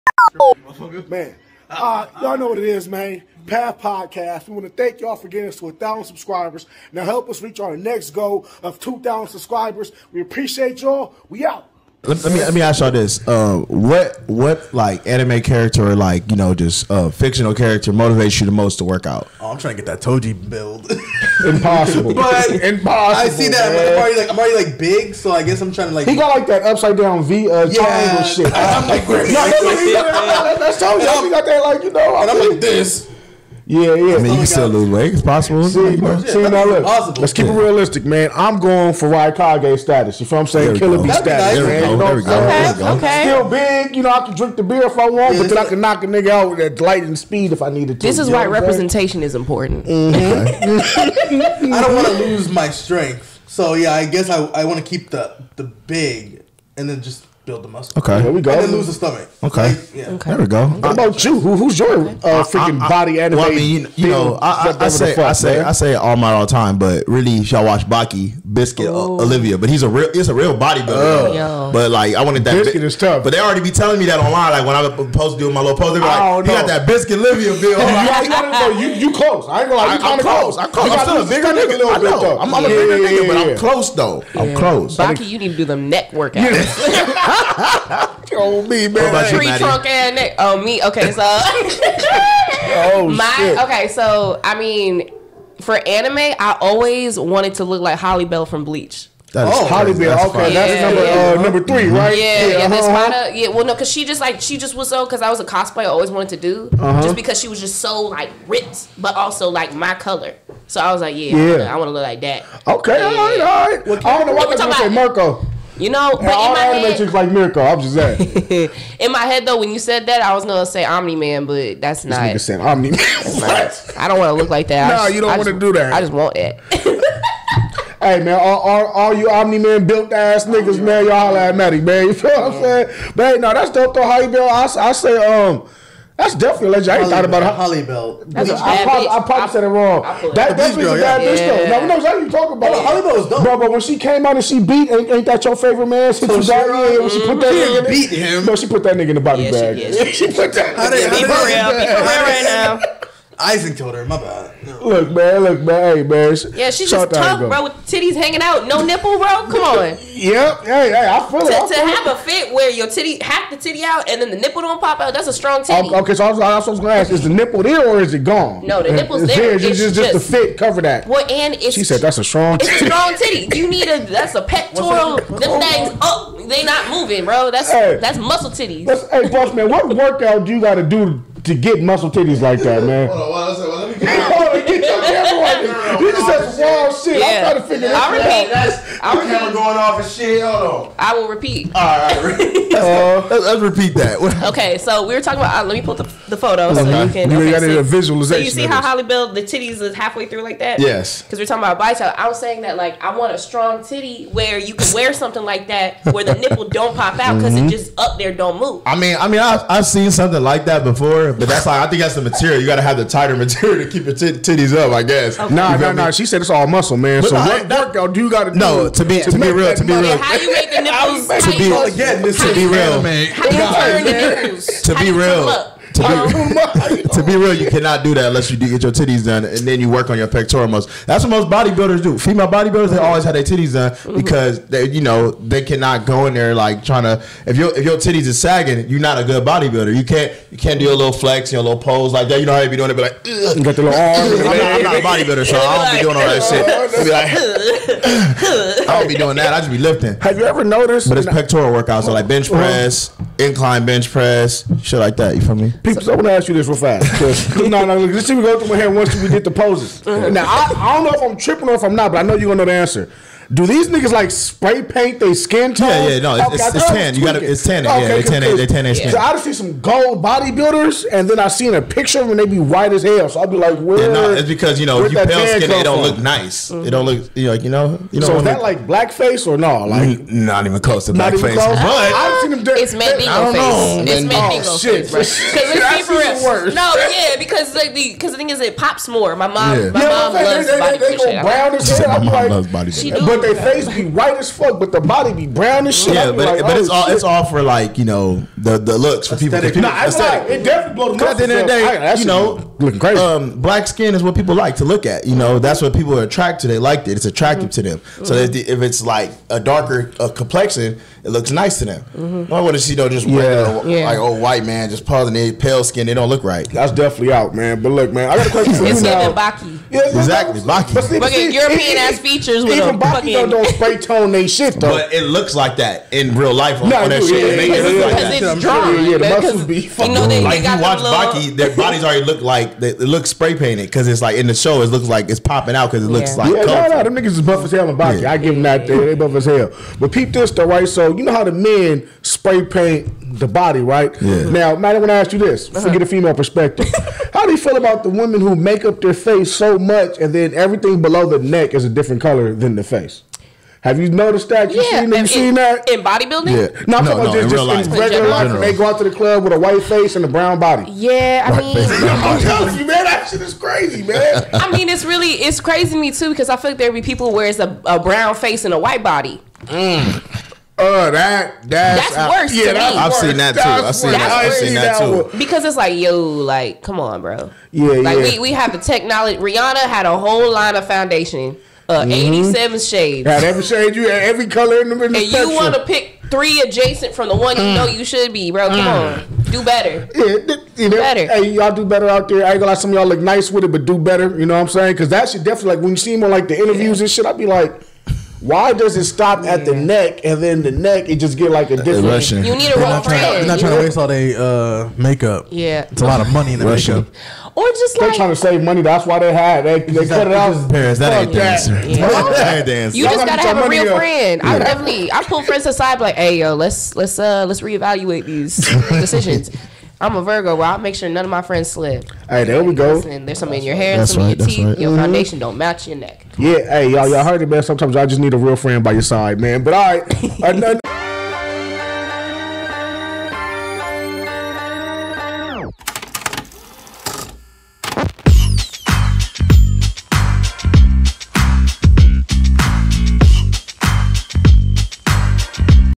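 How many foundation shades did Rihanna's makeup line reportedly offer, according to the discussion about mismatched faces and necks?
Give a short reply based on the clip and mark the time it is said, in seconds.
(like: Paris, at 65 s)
87, at 382 s.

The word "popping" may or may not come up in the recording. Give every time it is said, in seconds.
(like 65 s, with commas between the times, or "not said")
335 s.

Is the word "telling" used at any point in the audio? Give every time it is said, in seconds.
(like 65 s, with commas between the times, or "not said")
73 s, 362 s.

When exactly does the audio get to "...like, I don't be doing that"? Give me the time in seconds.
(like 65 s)
247 s.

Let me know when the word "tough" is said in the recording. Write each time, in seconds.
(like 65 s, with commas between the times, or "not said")
72 s, 157 s.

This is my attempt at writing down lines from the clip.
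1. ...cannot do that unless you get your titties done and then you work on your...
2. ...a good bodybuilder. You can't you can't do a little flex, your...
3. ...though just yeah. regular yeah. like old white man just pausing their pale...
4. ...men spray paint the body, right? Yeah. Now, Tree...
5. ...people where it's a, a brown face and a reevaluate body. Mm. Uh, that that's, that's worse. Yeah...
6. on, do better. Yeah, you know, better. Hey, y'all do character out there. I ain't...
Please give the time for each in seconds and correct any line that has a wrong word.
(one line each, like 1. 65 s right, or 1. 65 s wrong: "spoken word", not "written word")
1. 227 s right
2. 239 s right
3. 312 s right
4. 341 s wrong: "Matt", not "Tree"
5. 367 s wrong: "white", not "reevaluate"
6. 389 s wrong: "better", not "character".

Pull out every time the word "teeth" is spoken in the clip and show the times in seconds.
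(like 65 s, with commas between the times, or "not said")
424 s.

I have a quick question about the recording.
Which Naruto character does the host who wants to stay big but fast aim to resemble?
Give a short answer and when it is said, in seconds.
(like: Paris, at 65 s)
Raikage, at 39 s.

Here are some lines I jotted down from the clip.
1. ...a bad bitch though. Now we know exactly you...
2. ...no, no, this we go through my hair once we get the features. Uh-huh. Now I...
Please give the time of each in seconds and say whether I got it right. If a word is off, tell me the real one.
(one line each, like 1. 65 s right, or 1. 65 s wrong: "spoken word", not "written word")
1. 140 s right
2. 257 s wrong: "poses", not "features".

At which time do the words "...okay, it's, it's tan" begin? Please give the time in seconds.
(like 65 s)
266 s.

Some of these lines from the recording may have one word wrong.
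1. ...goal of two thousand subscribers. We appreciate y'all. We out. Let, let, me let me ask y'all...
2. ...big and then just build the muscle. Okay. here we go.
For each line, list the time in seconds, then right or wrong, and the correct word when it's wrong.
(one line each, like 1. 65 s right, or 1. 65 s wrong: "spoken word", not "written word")
1. 8 s right
2. 55 s right.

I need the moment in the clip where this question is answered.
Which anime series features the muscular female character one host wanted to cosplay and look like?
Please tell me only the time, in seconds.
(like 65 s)
98 s.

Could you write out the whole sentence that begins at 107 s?
just because she was just so like ripped, but also like my color.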